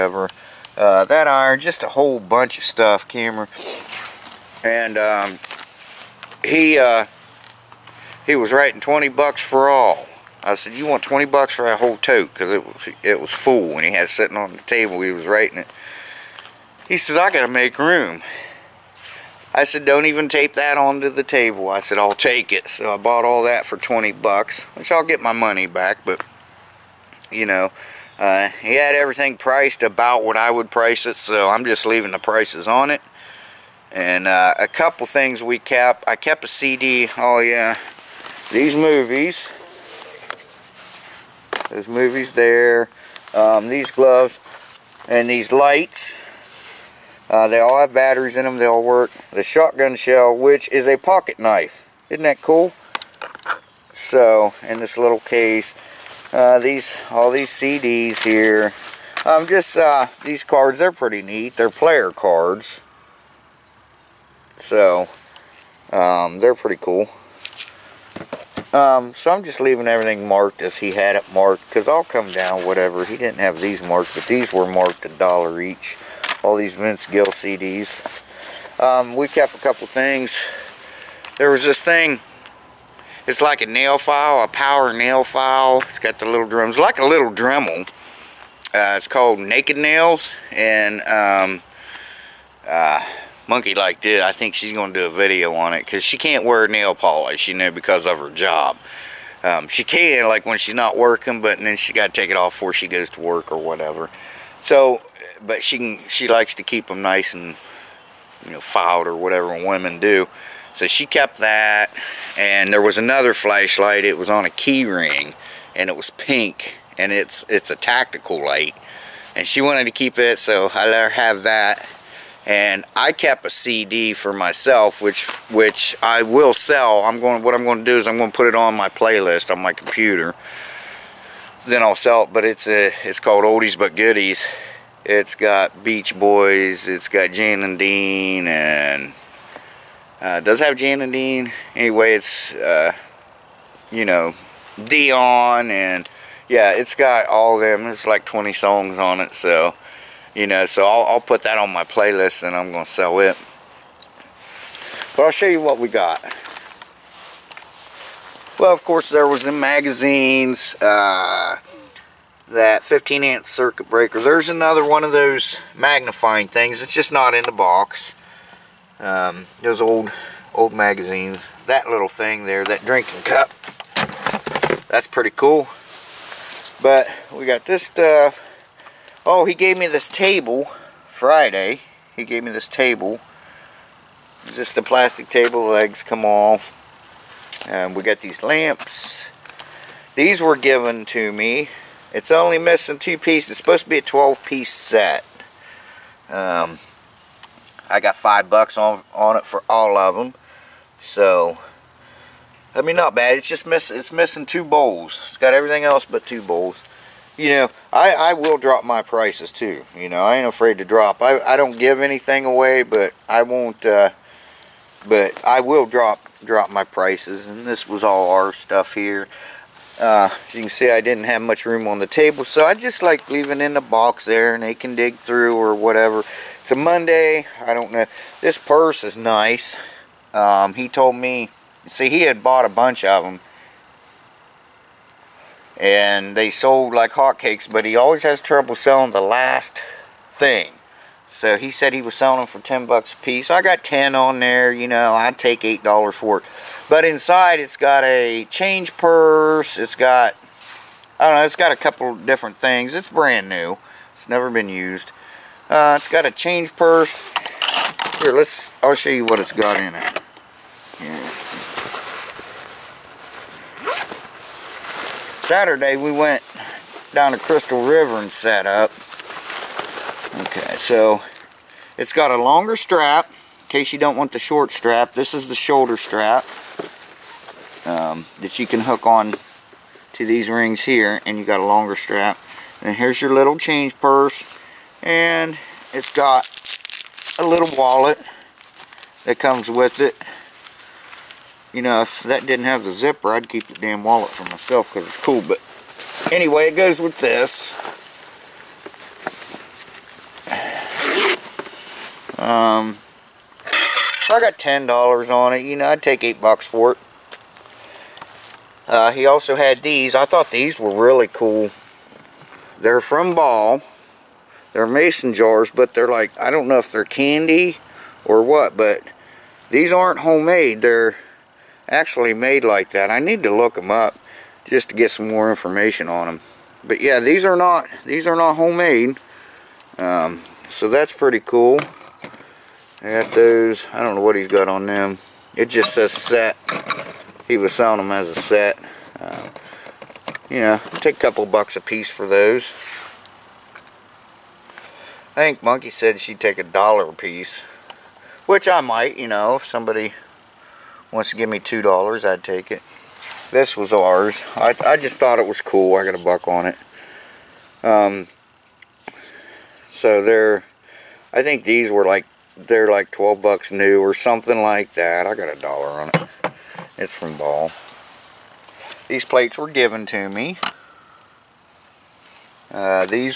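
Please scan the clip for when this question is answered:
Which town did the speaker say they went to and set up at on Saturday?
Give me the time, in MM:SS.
04:27.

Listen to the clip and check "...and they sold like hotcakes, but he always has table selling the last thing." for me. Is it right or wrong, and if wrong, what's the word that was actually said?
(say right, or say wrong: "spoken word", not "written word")
wrong: "trouble", not "table".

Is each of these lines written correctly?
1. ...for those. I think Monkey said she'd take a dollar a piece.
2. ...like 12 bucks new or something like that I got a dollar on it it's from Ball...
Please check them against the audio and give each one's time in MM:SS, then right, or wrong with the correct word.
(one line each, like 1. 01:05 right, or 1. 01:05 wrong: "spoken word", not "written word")
1. 05:42 right
2. 06:02 right.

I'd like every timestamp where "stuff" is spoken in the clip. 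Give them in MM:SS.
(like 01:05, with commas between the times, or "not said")
00:02, 02:57, 03:38.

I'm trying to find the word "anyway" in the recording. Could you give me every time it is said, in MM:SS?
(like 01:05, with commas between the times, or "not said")
02:21, 04:56.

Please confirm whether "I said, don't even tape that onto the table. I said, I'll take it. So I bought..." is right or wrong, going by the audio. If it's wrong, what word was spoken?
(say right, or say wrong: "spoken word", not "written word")
right.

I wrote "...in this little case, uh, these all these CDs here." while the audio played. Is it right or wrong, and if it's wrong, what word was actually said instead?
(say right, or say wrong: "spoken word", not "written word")
right.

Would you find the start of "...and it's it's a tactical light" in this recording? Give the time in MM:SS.
01:56.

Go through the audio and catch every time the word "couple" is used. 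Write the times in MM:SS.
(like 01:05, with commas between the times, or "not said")
00:34, 01:19, 04:11, 05:41.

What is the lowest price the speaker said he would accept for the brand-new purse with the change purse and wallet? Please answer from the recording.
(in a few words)
$8.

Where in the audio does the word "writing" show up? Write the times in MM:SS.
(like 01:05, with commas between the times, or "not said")
00:08, 00:15.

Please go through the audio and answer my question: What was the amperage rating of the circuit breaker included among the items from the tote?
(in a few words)
15 amp.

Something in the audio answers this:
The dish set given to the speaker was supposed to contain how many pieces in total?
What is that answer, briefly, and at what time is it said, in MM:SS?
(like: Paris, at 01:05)
12, at 03:14.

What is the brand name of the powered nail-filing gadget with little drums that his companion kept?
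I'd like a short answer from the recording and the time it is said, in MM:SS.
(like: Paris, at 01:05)
Naked Nails, at 01:29.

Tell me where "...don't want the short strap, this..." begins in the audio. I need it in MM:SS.
04:33.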